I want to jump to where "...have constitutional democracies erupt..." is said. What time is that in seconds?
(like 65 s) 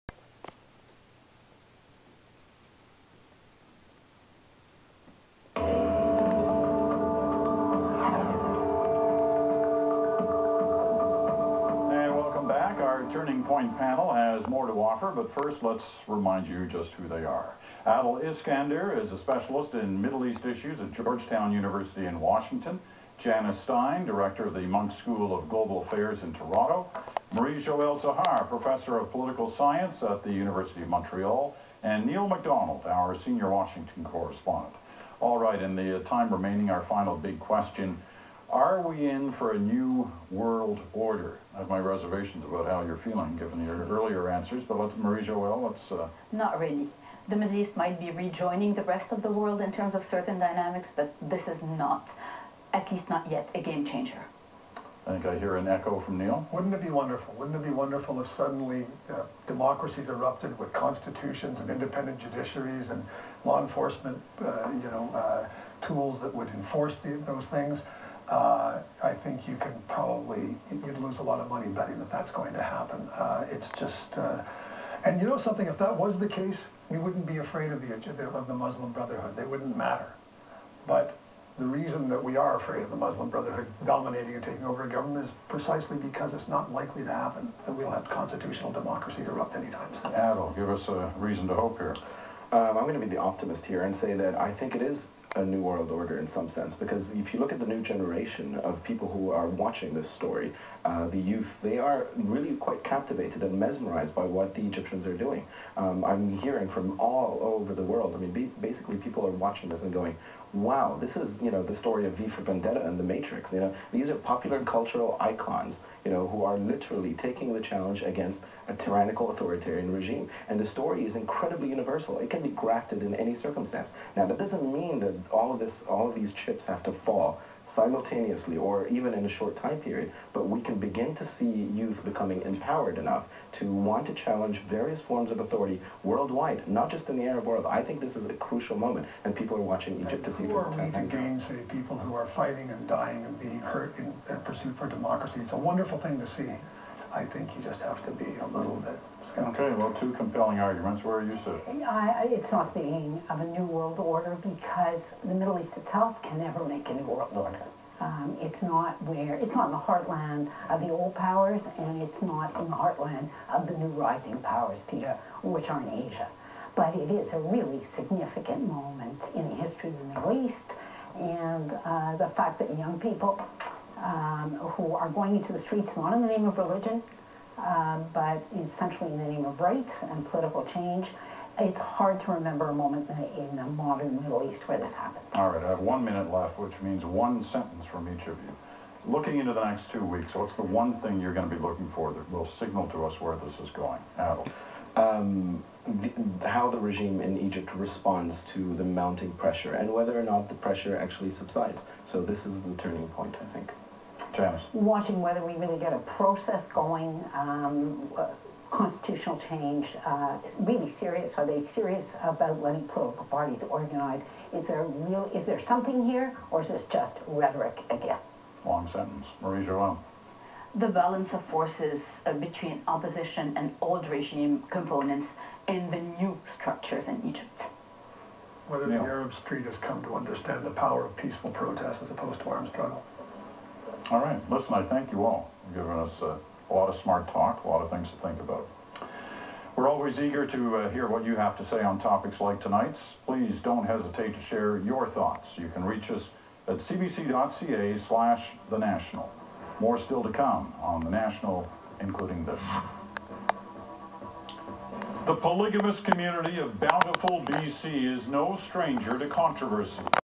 87 s.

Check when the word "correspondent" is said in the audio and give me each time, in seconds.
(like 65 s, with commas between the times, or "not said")
34 s.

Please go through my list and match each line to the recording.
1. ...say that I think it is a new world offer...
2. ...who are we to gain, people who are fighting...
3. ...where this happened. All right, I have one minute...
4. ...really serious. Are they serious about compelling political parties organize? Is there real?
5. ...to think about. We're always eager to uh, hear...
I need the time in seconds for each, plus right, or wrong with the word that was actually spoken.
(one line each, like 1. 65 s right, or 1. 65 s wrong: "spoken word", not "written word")
1. 93 s wrong: "order", not "offer"
2. 140 s right
3. 184 s right
4. 210 s wrong: "letting", not "compelling"
5. 238 s right.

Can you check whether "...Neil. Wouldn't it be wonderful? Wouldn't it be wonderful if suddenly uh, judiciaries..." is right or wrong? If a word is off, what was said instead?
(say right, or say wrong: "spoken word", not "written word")
wrong: "democracies", not "judiciaries".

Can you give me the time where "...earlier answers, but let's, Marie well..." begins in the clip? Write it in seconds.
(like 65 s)
43 s.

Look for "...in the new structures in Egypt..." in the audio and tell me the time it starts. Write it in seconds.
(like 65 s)
225 s.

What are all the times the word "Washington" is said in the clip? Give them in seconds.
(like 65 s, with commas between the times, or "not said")
22 s, 33 s.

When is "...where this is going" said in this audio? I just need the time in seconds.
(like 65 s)
193 s.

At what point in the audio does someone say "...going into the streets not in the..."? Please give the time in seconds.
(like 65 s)
175 s.